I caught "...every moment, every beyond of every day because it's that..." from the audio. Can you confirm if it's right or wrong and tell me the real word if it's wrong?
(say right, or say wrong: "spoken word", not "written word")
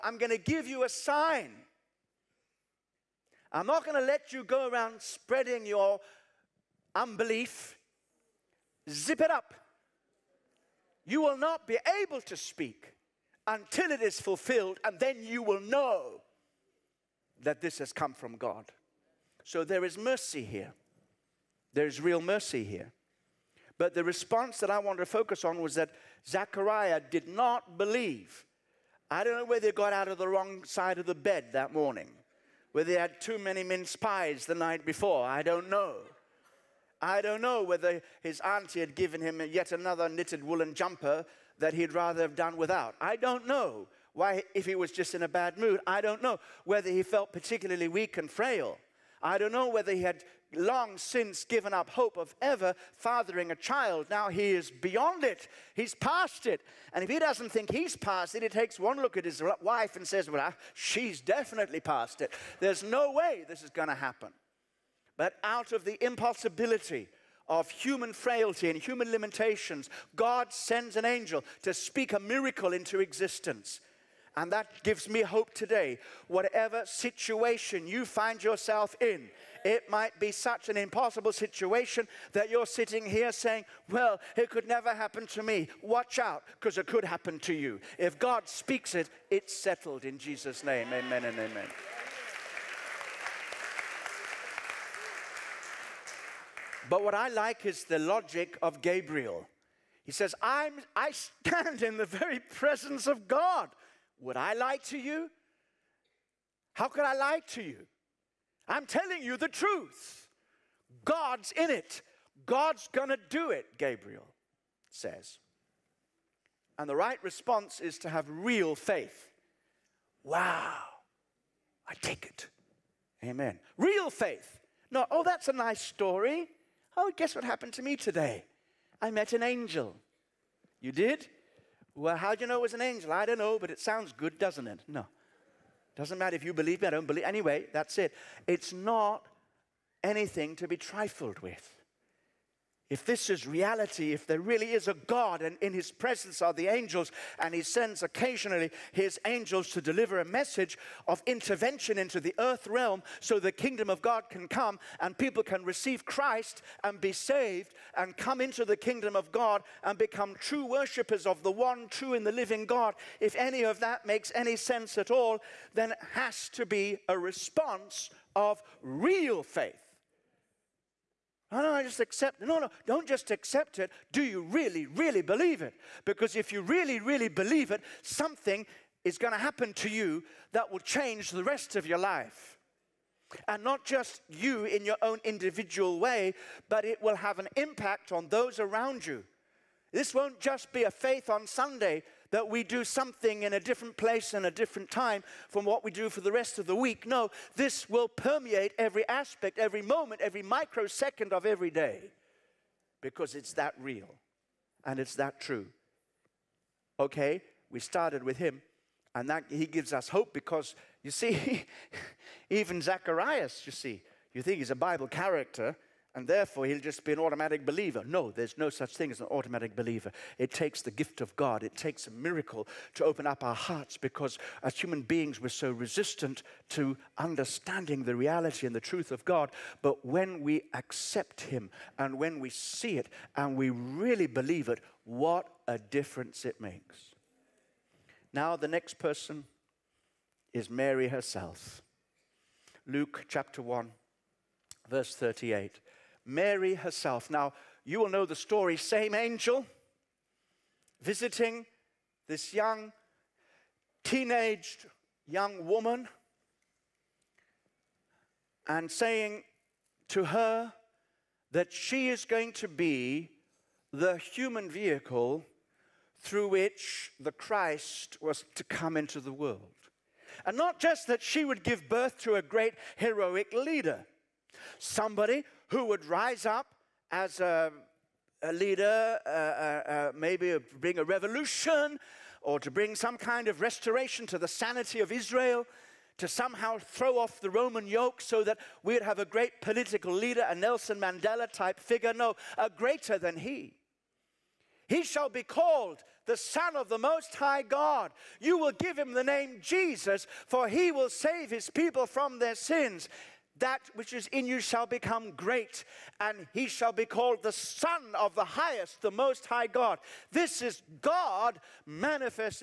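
wrong: "microsecond", not "beyond".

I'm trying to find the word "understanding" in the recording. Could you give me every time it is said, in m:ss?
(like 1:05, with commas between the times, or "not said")
3:47.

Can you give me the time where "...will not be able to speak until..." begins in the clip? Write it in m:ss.
0:11.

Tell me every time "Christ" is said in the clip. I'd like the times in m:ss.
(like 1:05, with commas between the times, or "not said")
2:36, 4:27.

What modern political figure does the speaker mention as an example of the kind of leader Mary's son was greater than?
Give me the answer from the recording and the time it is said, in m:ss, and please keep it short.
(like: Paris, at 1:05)
Nelson Mandela, at 4:50.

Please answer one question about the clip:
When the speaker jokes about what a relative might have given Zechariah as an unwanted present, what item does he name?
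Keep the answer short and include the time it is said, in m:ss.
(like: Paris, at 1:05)
knitted woolen jumper, at 0:40.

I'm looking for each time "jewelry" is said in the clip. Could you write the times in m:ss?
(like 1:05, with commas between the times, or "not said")
not said.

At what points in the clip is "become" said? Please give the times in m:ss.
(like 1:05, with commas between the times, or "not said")
2:39, 5:04.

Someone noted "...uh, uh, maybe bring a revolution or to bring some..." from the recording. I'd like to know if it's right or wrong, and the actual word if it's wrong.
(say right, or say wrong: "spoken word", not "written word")
right.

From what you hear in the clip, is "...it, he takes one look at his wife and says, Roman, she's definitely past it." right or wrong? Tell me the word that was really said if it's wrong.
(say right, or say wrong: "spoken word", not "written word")
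wrong: "Well", not "Roman".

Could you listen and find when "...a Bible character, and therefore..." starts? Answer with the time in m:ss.
3:34.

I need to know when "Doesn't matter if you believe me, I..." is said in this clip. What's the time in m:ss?
2:15.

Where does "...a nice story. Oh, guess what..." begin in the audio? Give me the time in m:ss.
2:05.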